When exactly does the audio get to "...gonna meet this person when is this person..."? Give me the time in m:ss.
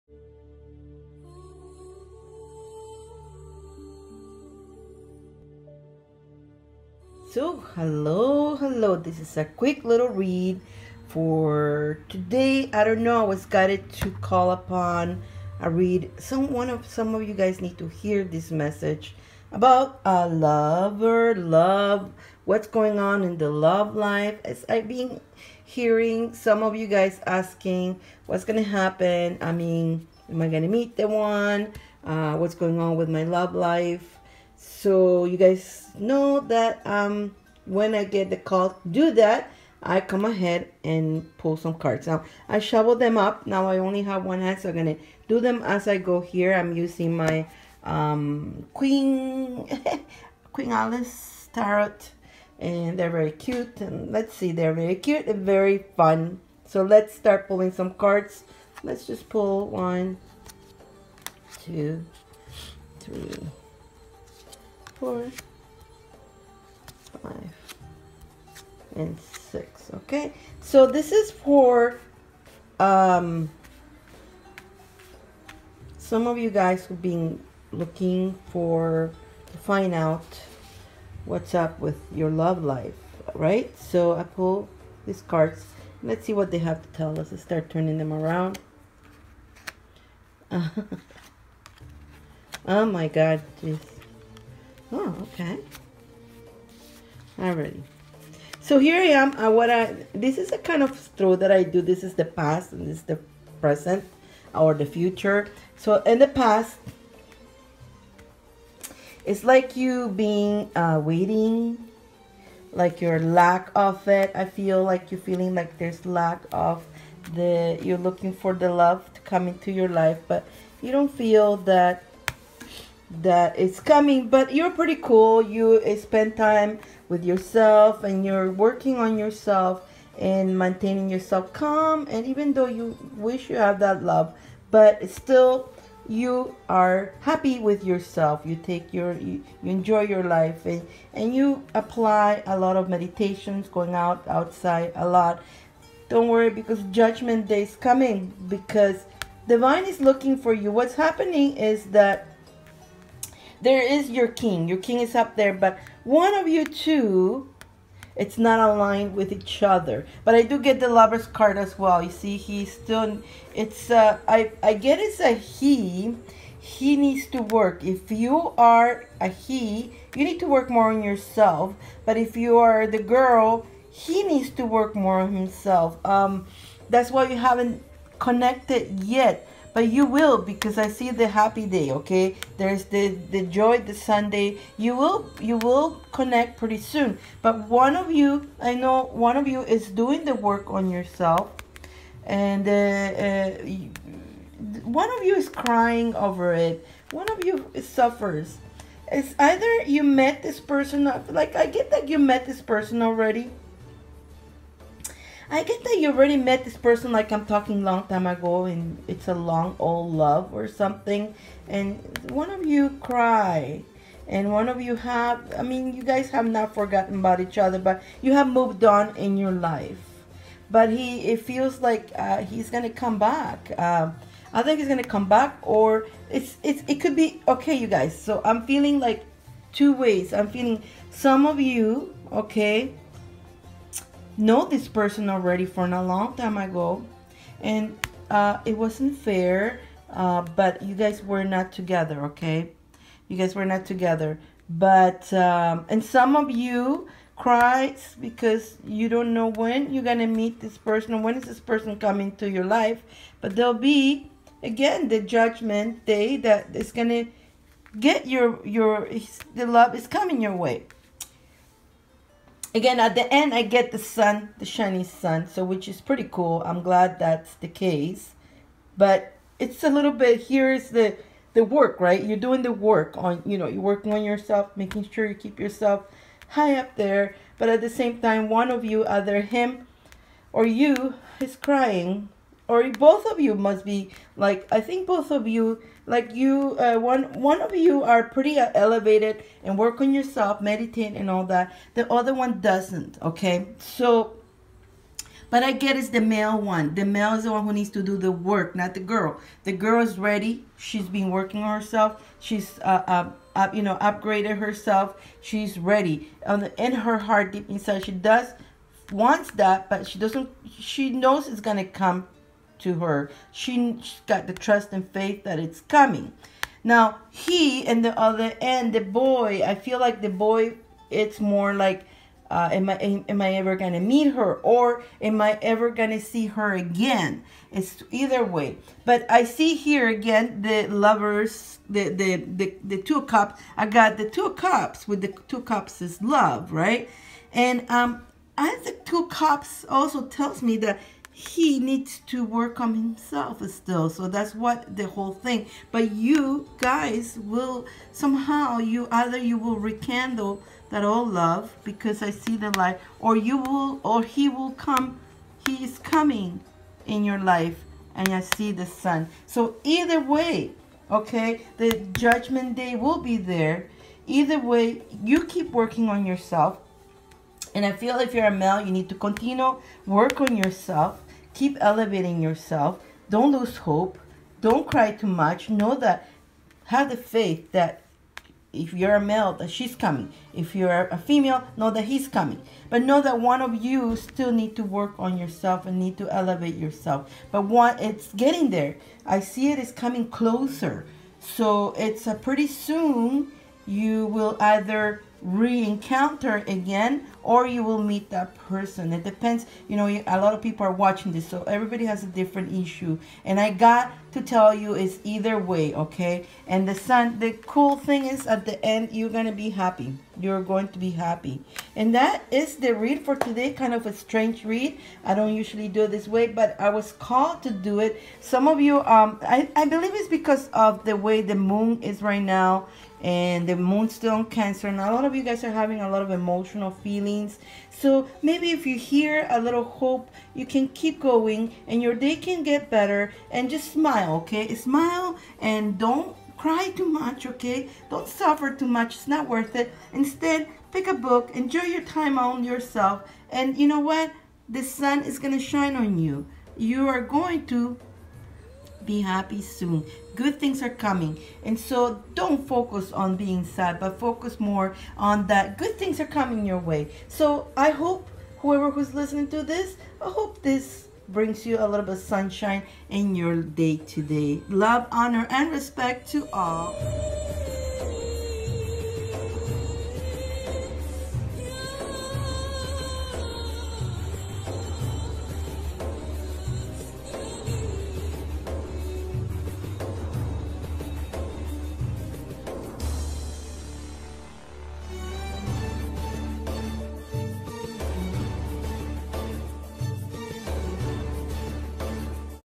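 4:10.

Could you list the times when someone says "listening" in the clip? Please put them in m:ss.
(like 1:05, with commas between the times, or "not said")
7:39.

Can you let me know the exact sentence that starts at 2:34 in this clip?
Your king is up there, but one of you two, it's not aligned with each other.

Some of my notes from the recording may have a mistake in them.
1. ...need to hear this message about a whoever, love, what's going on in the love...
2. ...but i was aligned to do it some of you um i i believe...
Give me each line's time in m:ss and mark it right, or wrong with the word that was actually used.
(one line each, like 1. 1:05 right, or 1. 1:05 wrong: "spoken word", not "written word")
1. 0:17 wrong: "lover", not "whoever"
2. 6:56 wrong: "called", not "aligned".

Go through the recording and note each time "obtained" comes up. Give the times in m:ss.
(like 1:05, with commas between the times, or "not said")
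not said.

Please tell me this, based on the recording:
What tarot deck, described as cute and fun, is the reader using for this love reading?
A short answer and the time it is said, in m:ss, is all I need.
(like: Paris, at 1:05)
Queen Alice tarot, at 0:50.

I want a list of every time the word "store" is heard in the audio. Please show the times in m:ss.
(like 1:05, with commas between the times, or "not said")
not said.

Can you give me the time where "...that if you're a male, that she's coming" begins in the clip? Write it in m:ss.
6:17.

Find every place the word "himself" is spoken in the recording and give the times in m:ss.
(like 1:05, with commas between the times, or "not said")
2:55, 5:42.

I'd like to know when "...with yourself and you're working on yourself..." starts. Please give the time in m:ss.
2:07.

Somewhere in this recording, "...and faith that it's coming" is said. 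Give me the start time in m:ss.
5:14.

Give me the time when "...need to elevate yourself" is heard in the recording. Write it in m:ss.
6:25.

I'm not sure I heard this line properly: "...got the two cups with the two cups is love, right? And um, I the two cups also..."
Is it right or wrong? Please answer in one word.
right.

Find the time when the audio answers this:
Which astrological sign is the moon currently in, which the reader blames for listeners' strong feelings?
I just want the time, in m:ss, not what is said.
7:04.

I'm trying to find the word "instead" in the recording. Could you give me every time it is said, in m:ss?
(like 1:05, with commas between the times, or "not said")
7:20.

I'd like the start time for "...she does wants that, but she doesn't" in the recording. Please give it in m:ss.
5:08.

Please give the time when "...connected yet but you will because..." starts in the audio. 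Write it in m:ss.
2:58.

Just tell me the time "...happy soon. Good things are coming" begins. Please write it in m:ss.
7:29.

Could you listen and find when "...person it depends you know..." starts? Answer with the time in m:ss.
6:38.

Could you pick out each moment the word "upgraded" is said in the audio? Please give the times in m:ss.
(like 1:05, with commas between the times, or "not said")
5:03.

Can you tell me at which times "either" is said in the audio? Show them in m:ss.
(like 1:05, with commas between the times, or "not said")
3:19, 4:39, 5:28, 5:49, 5:59, 6:04, 6:34, 6:45.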